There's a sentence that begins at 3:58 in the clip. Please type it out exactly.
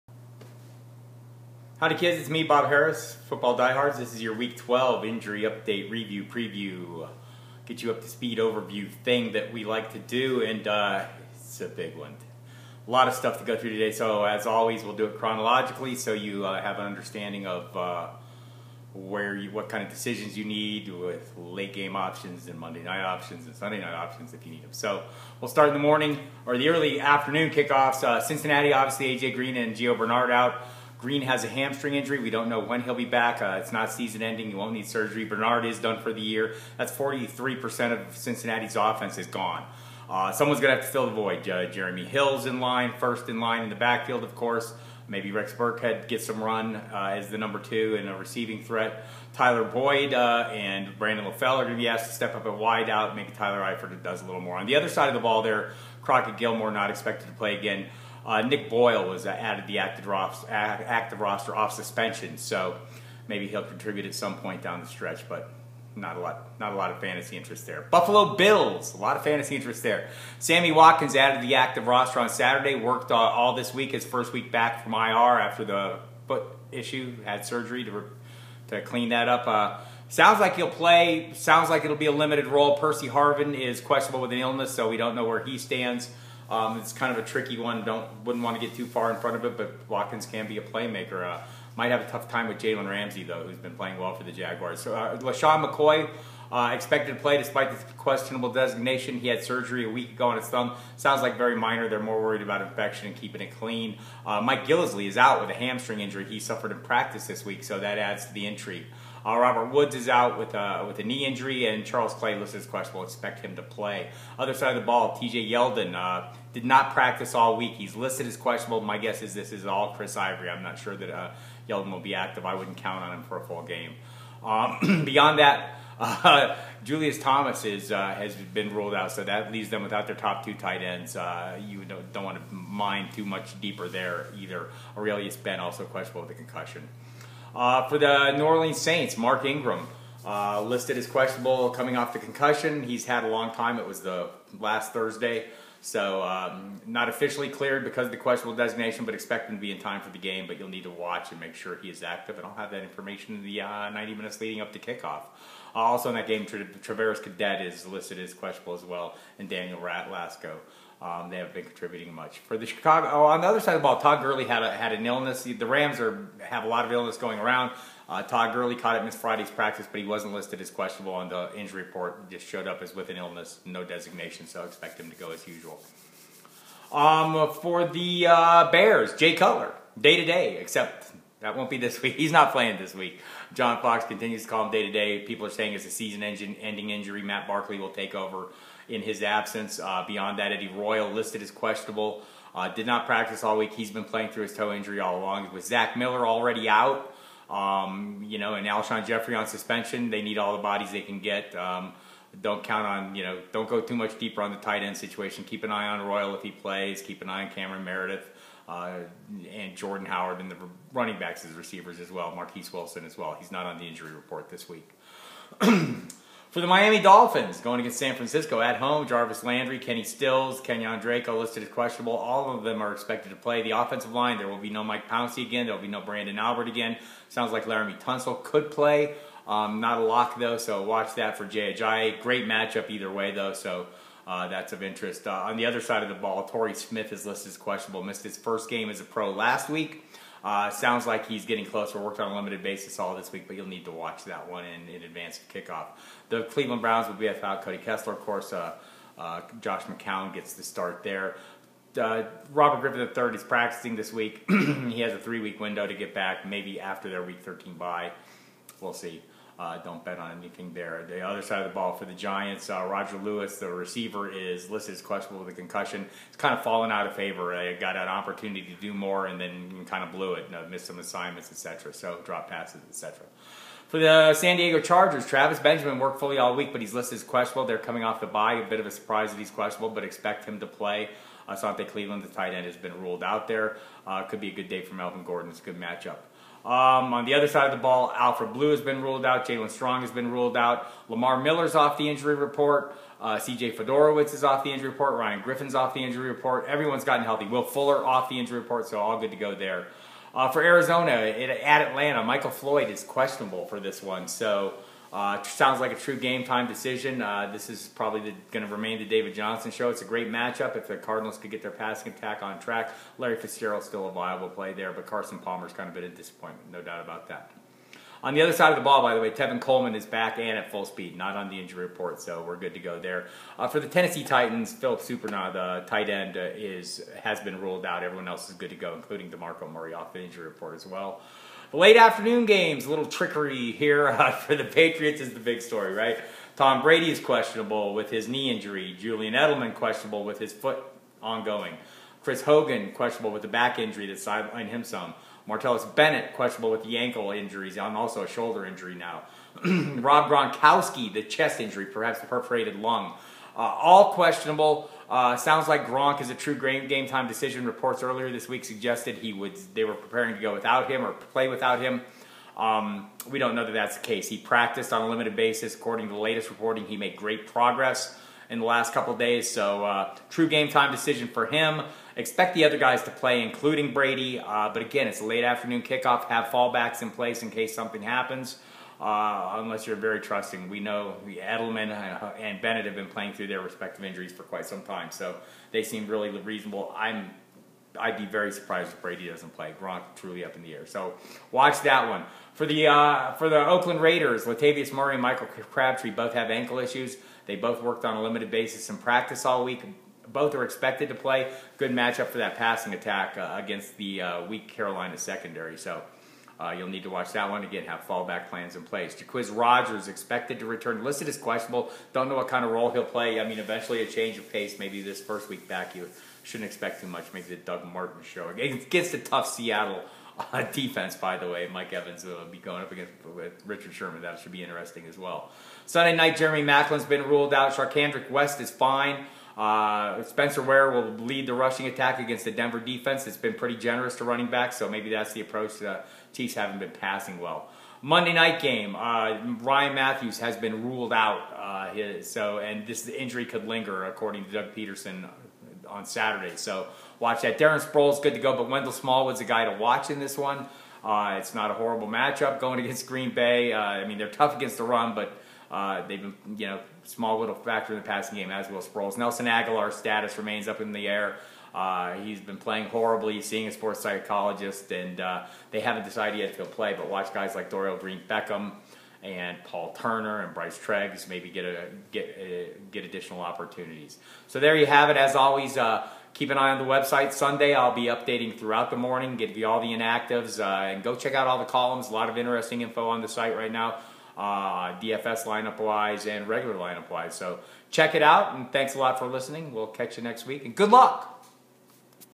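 Missed his first game as a pro last week.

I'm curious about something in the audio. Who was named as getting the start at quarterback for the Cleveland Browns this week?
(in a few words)
Josh McCown.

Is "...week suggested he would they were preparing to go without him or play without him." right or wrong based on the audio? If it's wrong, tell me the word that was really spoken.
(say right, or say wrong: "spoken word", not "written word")
right.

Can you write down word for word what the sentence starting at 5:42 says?
Chris Hogan questionable with the back injury that sidelined him some.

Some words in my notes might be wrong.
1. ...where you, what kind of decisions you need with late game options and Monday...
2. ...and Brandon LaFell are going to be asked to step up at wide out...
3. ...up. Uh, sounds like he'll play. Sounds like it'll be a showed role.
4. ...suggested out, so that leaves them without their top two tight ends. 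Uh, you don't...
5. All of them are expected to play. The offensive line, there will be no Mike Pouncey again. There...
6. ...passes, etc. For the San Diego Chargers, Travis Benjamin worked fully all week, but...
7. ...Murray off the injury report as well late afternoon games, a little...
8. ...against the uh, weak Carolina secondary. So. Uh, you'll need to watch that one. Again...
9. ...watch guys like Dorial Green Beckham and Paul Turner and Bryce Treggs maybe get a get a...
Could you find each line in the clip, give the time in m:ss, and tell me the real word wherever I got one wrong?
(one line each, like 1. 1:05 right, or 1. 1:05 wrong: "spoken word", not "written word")
1. 0:18 right
2. 0:50 right
3. 1:19 wrong: "limited", not "showed"
4. 2:08 wrong: "ruled", not "suggested"
5. 3:42 right
6. 4:32 right
7. 5:29 right
8. 6:43 right
9. 7:47 right.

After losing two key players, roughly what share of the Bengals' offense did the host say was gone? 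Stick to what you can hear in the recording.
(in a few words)
43%.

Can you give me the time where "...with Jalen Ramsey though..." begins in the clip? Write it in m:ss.
1:32.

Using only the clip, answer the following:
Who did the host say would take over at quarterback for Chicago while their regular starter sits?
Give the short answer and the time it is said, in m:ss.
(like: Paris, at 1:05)
Matt Barkley, at 3:07.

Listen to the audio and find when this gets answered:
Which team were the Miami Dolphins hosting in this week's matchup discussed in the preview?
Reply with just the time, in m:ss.
3:37.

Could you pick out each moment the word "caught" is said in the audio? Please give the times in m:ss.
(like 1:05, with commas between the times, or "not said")
2:48.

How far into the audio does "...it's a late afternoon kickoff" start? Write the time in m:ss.
6:15.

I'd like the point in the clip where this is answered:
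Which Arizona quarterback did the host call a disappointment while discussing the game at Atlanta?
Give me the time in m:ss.
5:15.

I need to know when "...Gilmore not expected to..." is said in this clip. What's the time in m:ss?
0:56.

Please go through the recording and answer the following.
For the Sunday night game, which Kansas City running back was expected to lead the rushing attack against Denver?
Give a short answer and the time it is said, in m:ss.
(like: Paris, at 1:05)
Spencer Ware, at 7:10.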